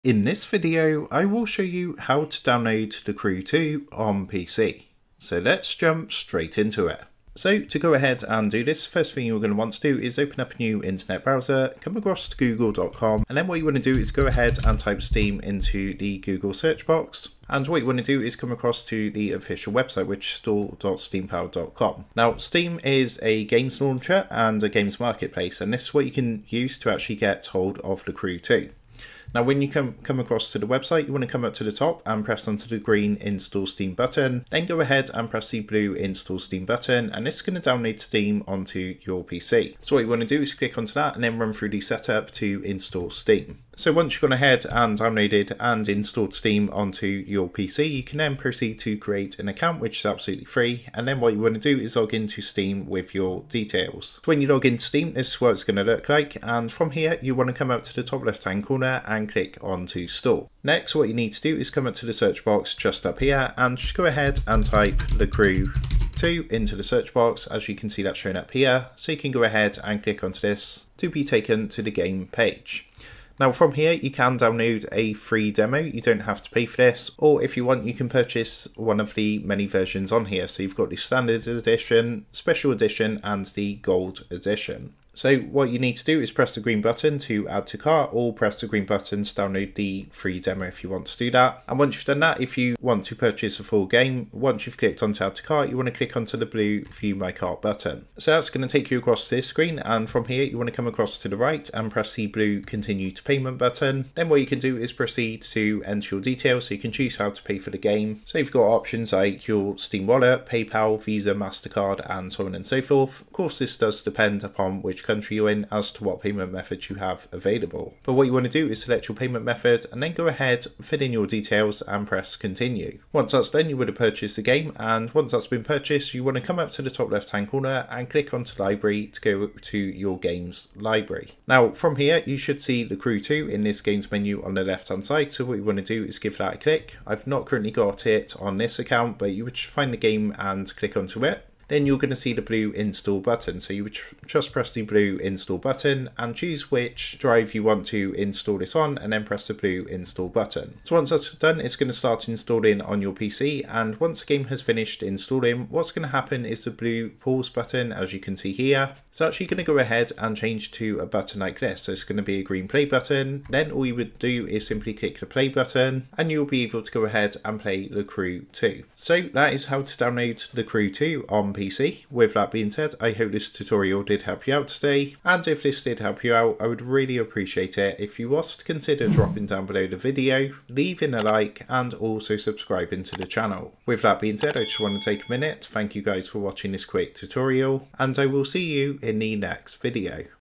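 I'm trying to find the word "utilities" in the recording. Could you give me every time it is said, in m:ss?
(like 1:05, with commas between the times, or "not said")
not said.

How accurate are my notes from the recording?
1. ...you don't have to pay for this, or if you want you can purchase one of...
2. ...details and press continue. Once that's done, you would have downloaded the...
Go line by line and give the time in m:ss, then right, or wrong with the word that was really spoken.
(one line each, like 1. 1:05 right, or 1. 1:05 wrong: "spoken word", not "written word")
1. 1:15 right
2. 2:01 wrong: "purchased", not "downloaded".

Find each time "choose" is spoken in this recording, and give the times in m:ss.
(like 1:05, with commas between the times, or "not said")
1:46, 2:26.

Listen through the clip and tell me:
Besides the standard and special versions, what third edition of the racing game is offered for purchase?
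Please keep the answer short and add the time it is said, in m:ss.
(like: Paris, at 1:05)
Gold edition, at 1:23.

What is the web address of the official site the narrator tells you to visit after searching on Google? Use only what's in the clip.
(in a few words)
store.steampowered.com.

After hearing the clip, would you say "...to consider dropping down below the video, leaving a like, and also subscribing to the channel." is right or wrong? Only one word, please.
right.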